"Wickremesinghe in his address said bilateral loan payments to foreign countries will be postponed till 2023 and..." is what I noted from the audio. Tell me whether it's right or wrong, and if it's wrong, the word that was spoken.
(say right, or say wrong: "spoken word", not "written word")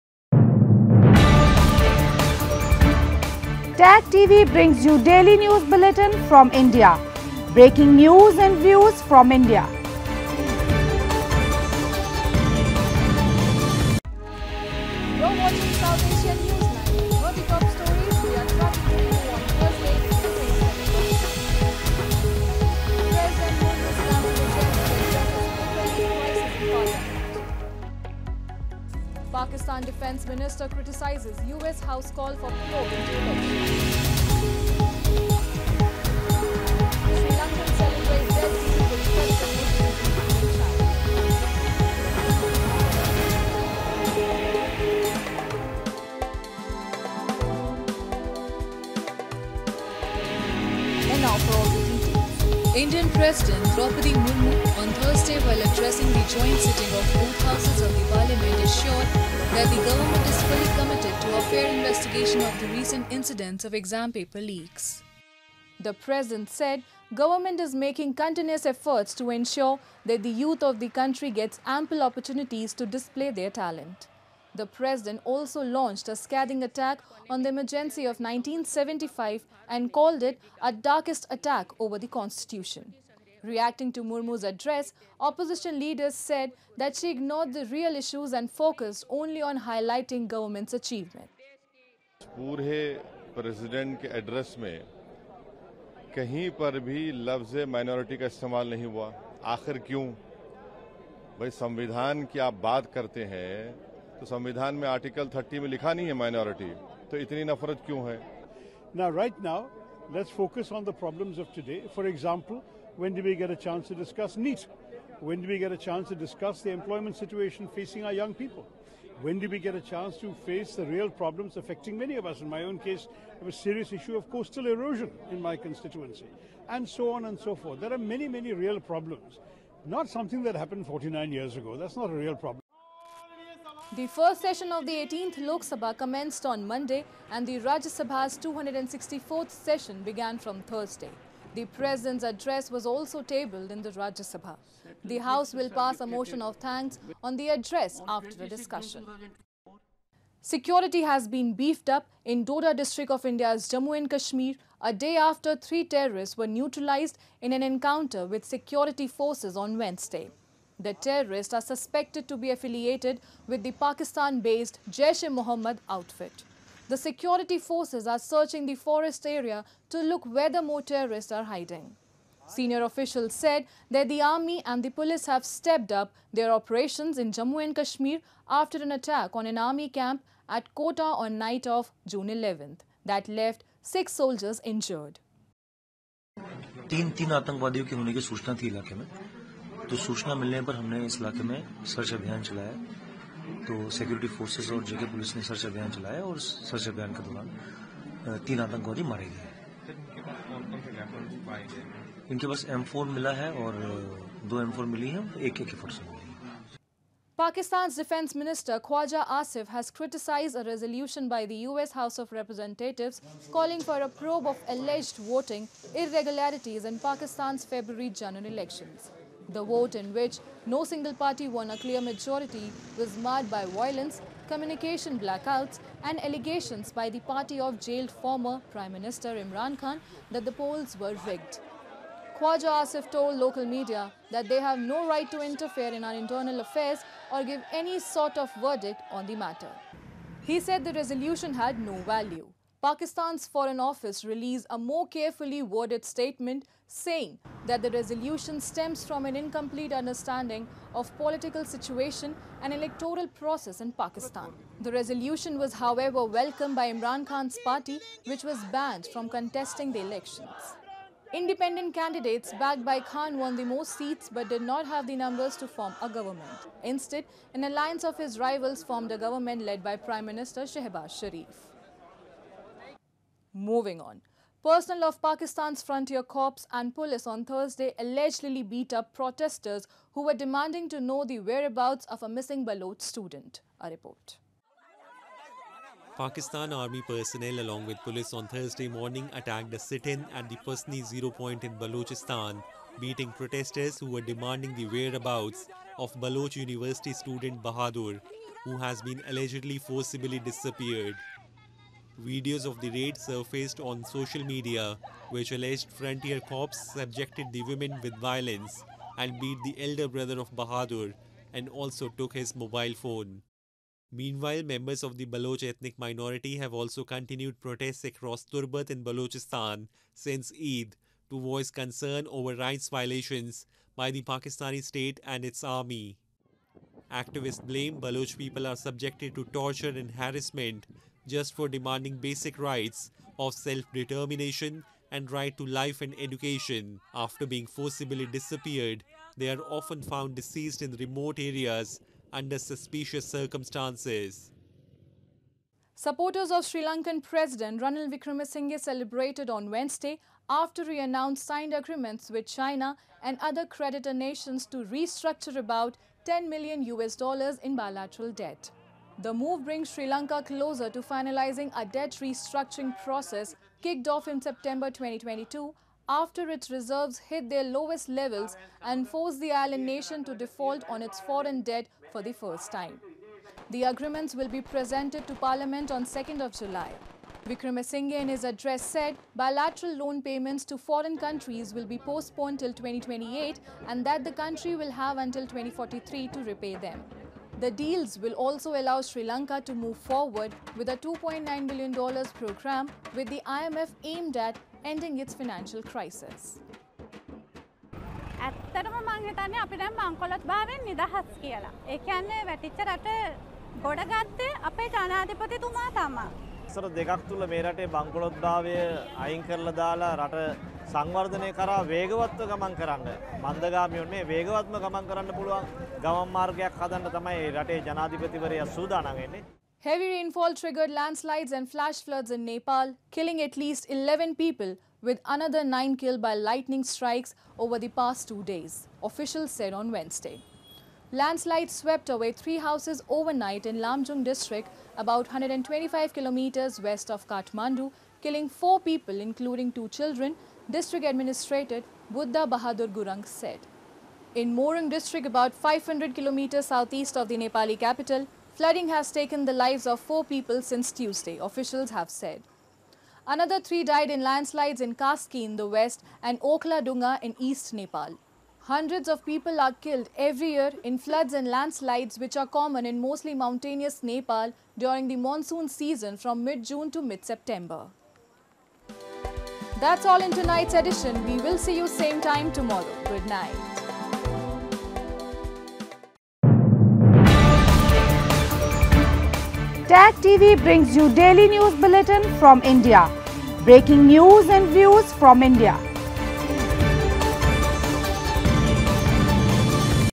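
wrong: "2028", not "2023".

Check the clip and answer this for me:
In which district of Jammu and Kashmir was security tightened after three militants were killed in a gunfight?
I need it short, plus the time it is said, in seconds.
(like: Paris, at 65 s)
Doda, at 152 s.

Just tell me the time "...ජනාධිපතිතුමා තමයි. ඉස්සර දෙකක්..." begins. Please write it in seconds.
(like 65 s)
404 s.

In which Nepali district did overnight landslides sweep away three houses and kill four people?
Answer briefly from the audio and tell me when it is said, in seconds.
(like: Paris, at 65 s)
Lamjung, at 433 s.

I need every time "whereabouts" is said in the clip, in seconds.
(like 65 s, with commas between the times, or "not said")
281 s, 294 s.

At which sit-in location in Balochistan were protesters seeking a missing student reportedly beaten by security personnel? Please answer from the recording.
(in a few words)
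Pasni Zero Point.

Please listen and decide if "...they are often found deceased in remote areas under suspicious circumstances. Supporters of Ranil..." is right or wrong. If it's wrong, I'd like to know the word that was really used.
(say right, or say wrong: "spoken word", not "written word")
wrong: "Sri", not "Ranil".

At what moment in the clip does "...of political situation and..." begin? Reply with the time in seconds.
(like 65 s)
250 s.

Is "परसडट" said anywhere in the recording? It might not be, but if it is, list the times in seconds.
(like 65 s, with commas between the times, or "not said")
93 s.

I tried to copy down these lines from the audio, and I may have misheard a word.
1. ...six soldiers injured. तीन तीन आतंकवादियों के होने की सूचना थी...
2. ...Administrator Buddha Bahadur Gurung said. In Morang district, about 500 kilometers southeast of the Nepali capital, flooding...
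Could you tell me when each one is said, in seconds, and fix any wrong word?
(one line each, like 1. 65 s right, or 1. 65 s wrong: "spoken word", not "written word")
1. 183 s right
2. 441 s right.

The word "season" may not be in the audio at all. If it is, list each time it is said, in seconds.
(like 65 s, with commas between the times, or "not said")
465 s.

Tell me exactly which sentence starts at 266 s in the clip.
Instead, an alliance of his rivals formed a government led by Prime Minister Shehbaz Sharif.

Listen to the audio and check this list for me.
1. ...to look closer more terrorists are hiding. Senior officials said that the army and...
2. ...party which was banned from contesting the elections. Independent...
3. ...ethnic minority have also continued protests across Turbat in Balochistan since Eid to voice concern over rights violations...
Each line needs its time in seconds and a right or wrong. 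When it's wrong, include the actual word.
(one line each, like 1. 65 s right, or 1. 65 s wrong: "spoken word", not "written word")
1. 169 s wrong: "whether", not "closer"
2. 257 s right
3. 315 s right.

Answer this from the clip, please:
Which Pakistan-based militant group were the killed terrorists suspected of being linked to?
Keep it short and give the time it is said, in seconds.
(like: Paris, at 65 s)
Jaish-e-Mohammed, at 164 s.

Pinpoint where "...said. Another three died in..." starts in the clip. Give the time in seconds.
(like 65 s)
452 s.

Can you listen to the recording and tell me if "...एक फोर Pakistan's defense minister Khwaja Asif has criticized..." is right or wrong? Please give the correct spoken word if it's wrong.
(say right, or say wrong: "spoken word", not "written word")
right.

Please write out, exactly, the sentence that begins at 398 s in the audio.
ඇත්තටම මං හිතන්නේ අපි දැන් මංකොලොත් භාවයෙන් නිදහස් කියලා.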